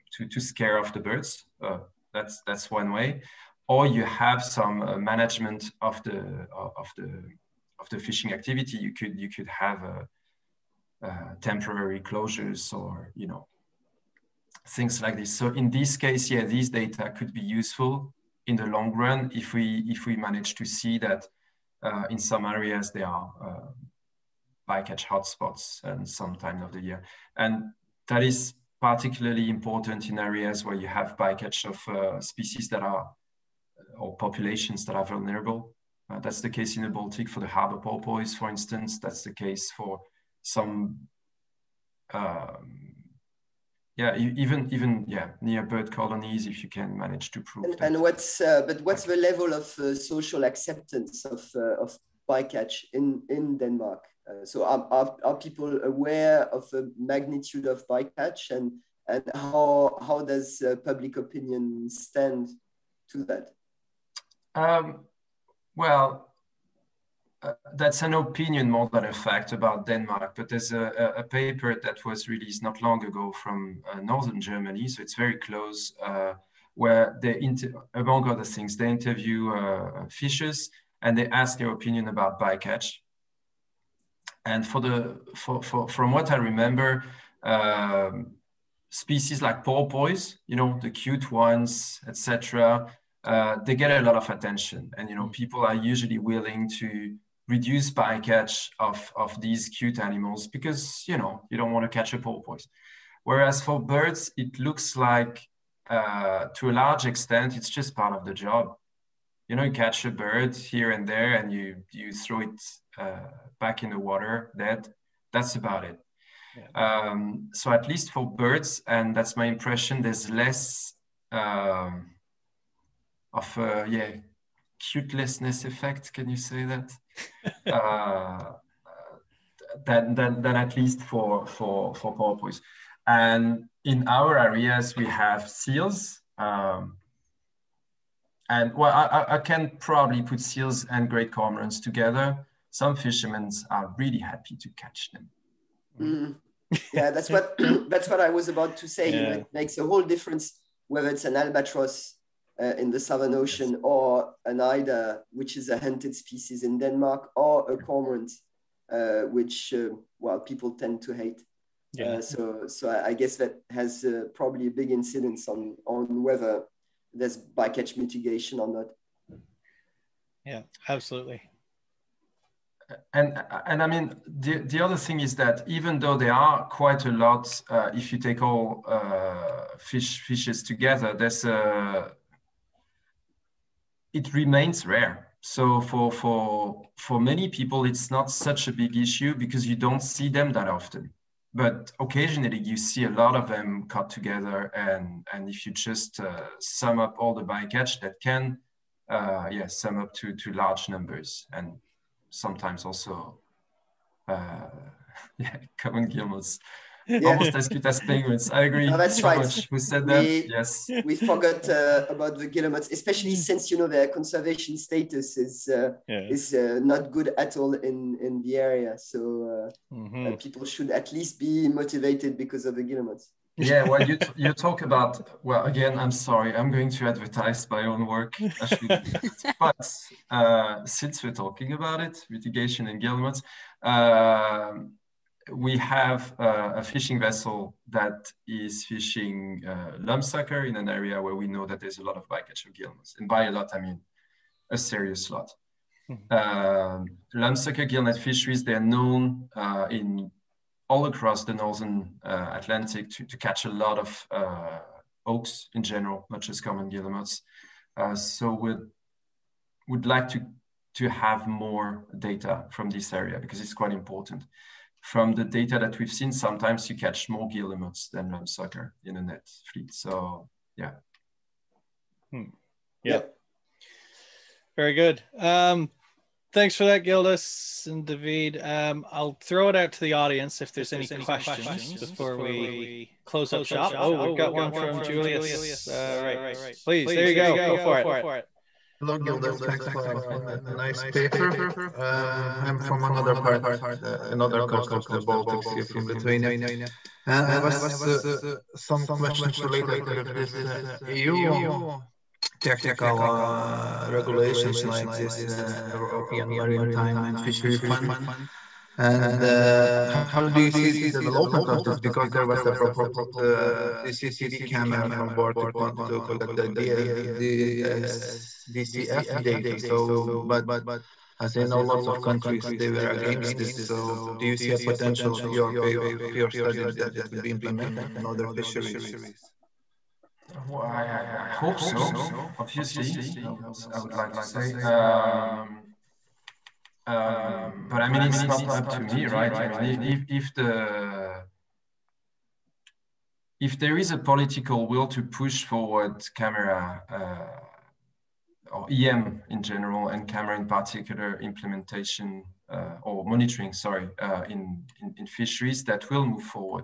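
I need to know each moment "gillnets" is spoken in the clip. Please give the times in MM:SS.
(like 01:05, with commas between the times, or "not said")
04:02, 04:07.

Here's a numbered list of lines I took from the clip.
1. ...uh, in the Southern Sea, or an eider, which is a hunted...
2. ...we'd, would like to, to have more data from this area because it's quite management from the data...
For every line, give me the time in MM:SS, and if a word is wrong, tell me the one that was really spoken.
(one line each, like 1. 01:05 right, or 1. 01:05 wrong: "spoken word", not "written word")
1. 02:32 wrong: "Ocean", not "Sea"
2. 04:18 wrong: "important", not "management".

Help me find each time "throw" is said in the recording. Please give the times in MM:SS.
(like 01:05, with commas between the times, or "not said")
01:52, 04:39.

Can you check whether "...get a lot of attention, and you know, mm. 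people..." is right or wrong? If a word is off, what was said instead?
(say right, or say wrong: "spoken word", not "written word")
right.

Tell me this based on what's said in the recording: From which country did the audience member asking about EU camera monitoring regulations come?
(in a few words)
Lithuania.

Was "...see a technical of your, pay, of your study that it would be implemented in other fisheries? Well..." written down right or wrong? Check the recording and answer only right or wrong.
wrong.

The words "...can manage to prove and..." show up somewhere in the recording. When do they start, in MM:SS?
00:46.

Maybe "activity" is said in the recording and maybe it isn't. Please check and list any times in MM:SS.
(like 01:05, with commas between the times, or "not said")
00:08.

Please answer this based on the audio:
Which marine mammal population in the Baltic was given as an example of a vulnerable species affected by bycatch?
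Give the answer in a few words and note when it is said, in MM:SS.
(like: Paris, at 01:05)
Harbor porpoise, at 00:37.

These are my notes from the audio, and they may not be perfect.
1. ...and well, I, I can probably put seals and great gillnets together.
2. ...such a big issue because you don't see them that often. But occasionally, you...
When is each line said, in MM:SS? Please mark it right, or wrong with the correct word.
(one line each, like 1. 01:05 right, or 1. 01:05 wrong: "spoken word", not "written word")
1. 02:18 wrong: "cormorants", not "gillnets"
2. 03:08 right.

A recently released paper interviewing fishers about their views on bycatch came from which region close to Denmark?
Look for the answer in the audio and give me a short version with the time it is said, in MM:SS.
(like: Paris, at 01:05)
Northern Germany, at 01:14.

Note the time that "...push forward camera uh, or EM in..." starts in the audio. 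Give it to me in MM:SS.
05:45.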